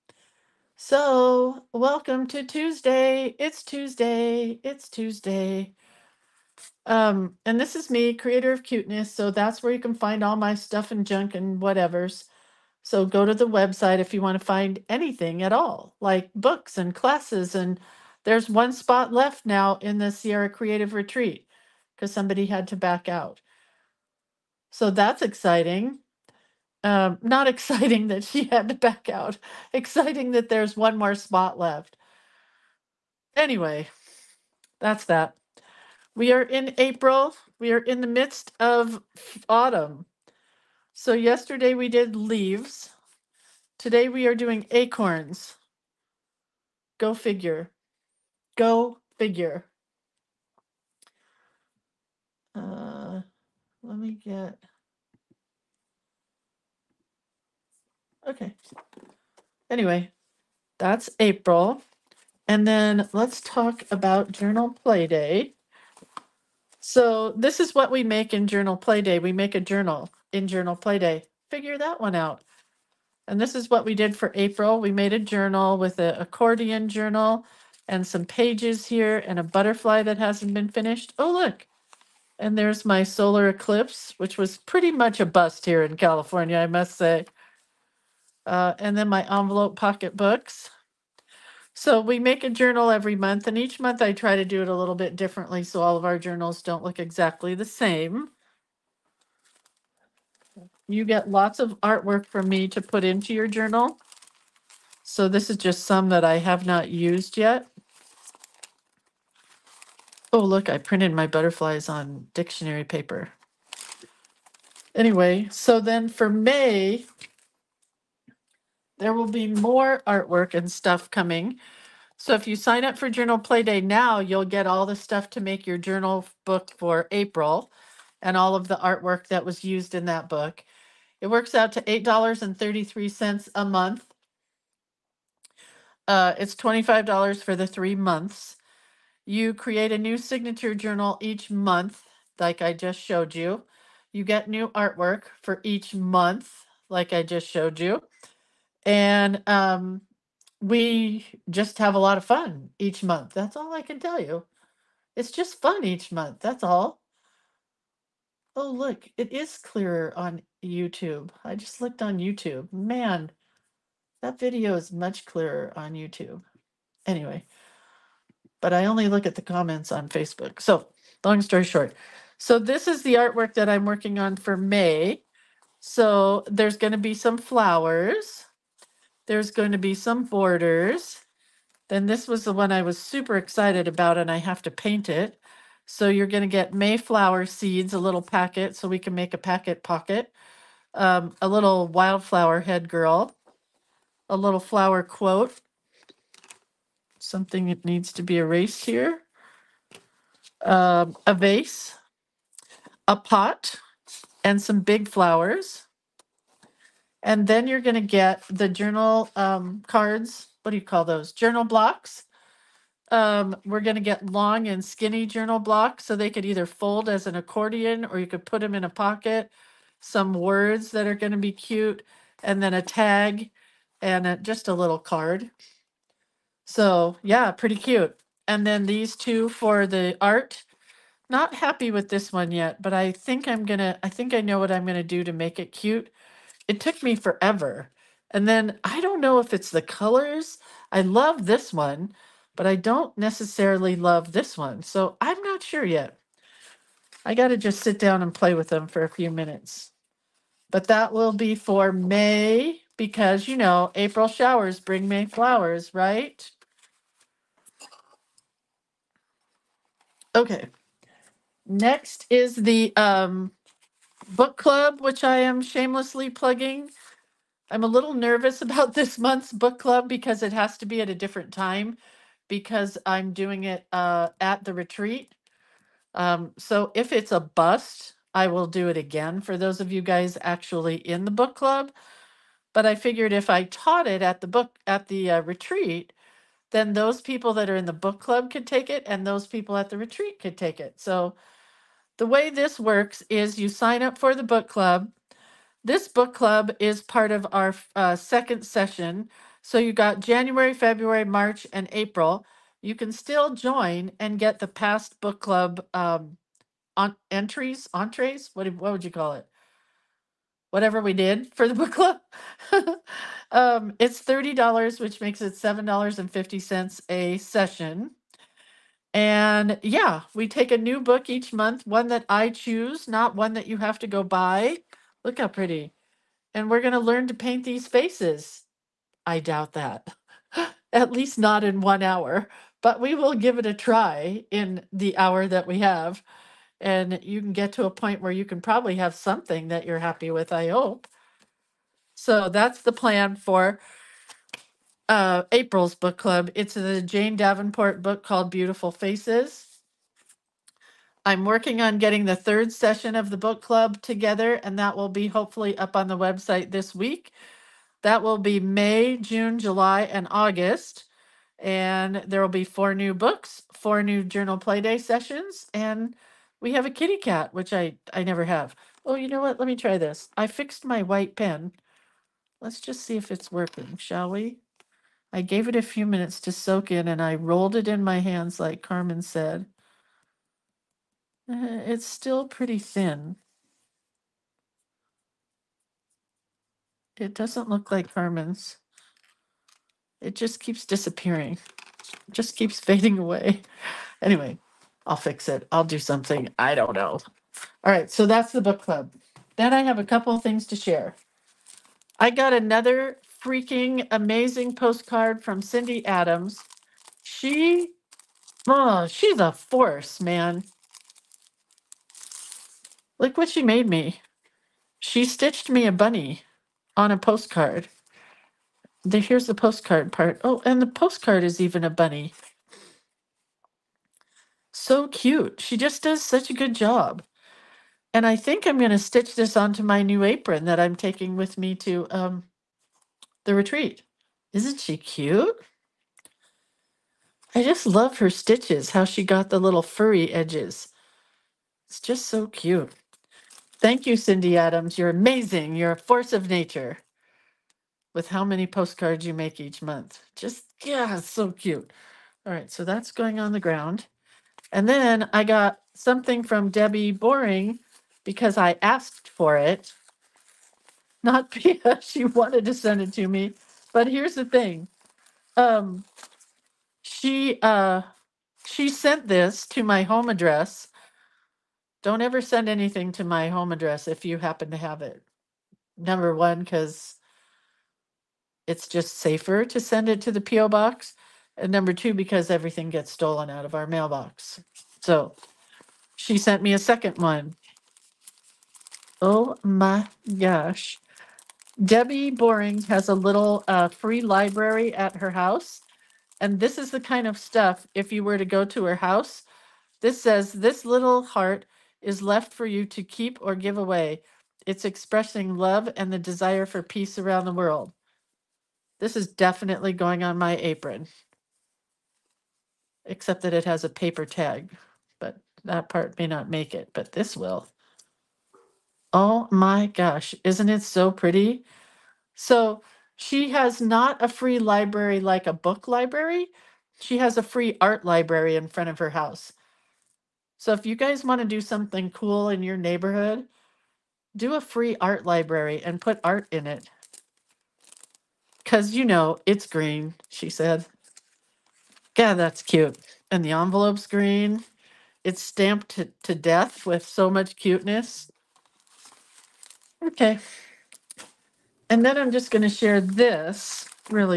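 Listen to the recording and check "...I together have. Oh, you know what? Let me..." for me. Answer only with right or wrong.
wrong.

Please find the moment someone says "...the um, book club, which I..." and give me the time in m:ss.
4:22.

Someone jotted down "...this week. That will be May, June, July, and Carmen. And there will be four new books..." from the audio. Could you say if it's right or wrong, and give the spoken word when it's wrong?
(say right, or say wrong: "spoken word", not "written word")
wrong: "August", not "Carmen".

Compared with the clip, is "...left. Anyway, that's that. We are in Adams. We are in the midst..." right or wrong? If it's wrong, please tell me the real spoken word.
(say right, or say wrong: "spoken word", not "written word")
wrong: "April", not "Adams".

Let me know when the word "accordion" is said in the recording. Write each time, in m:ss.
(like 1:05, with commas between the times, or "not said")
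1:16, 3:37.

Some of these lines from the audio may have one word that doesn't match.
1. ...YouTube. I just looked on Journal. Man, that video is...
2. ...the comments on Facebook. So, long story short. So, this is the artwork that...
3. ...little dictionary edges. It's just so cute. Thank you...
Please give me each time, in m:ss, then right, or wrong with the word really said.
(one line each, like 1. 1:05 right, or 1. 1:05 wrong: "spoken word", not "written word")
1. 2:40 wrong: "YouTube", not "Journal"
2. 2:49 right
3. 7:19 wrong: "furry", not "dictionary".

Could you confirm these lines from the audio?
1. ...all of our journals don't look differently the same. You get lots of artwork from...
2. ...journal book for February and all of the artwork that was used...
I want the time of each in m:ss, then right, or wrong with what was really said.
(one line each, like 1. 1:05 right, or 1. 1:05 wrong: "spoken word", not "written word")
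1. 1:35 wrong: "exactly", not "differently"
2. 2:05 wrong: "April", not "February".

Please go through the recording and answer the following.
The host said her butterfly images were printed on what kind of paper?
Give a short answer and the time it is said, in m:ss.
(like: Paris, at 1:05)
Dictionary paper, at 1:52.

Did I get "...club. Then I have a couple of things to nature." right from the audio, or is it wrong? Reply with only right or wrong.
wrong.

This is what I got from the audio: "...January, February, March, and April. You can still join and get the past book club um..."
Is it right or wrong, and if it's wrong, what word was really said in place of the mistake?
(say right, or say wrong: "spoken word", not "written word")
right.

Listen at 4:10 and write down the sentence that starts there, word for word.
But that will be for May because, you know, April showers bring May flowers, right?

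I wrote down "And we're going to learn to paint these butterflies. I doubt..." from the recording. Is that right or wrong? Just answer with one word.
wrong.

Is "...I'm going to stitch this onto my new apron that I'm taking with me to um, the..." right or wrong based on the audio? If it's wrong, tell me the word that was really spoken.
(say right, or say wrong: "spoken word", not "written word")
right.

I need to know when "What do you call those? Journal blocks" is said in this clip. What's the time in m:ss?
3:30.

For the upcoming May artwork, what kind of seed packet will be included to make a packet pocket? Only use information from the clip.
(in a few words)
Mayflower seeds.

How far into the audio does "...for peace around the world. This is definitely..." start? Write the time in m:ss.
8:26.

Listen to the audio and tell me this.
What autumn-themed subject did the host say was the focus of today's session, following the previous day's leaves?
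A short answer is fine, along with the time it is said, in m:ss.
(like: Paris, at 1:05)
Acorns, at 0:44.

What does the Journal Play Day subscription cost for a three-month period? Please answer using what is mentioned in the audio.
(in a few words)
$25.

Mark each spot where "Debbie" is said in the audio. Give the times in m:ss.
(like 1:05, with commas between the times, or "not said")
7:36, 8:11.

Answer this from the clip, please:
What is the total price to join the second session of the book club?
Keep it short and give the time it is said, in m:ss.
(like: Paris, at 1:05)
$30, at 5:14.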